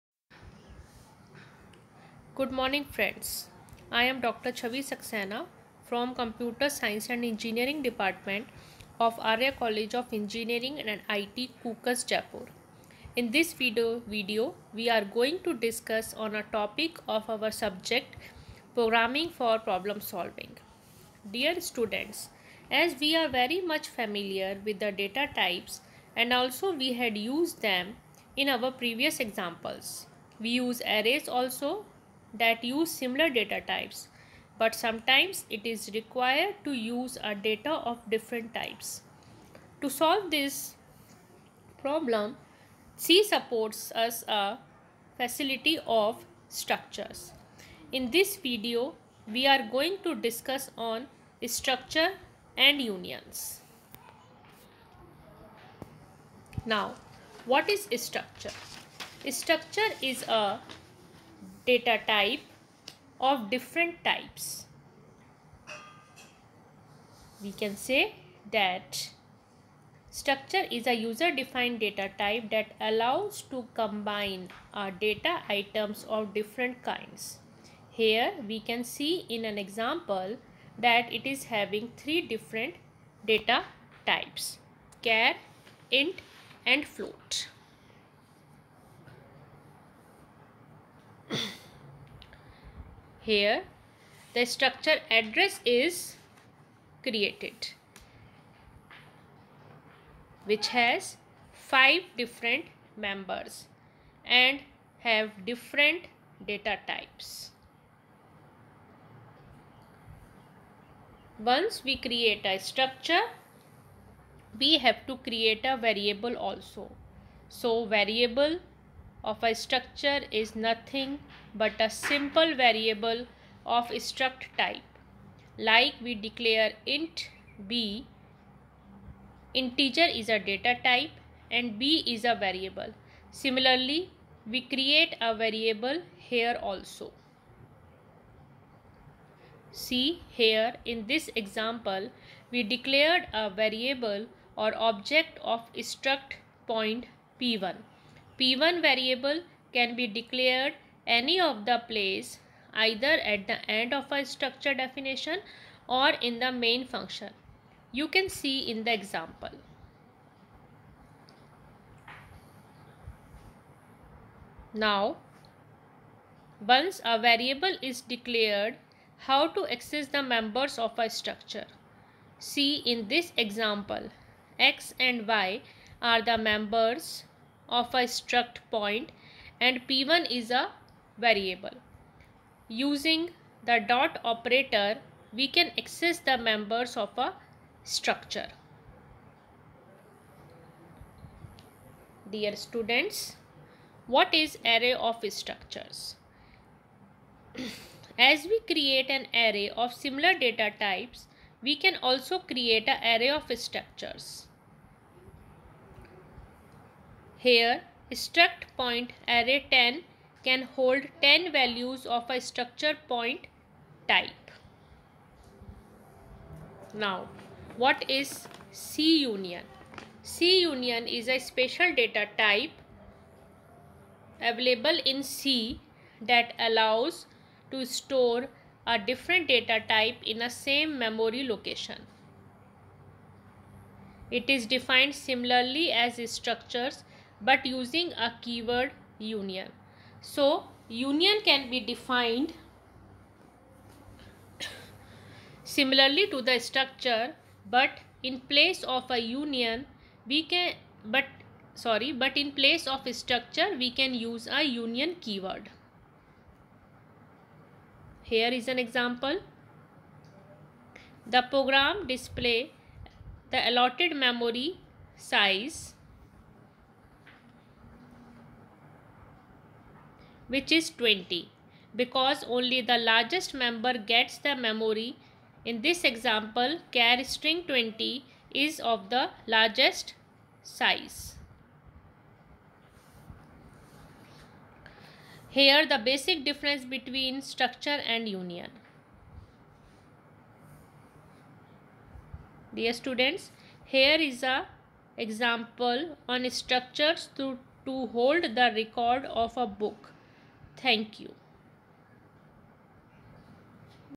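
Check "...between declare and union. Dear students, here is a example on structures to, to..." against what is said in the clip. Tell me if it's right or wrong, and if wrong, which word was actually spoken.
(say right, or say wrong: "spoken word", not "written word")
wrong: "structure", not "declare".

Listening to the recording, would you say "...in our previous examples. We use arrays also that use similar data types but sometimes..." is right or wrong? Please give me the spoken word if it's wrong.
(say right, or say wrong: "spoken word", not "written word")
right.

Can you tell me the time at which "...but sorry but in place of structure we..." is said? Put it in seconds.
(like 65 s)
251 s.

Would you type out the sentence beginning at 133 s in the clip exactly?
Similarly, we create a variable here also.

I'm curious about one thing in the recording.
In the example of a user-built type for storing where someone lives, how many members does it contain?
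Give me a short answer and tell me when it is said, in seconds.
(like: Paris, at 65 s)
5, at 101 s.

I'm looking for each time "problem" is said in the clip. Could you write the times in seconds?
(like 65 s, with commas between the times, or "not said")
19 s, 41 s.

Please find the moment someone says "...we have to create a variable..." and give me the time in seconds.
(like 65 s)
114 s.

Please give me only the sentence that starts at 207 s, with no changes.
Here, struct point array 10 can hold 10 values of a structure point type.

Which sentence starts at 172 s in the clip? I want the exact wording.
See in this example, x and y are the members of a struct point and P1 is a variable.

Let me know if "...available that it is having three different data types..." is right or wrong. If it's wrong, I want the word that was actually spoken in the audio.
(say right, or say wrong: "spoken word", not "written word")
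wrong: "example", not "available".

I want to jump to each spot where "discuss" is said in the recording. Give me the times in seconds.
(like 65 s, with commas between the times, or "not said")
15 s, 50 s.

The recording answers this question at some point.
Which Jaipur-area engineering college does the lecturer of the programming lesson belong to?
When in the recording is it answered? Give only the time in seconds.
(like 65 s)
9 s.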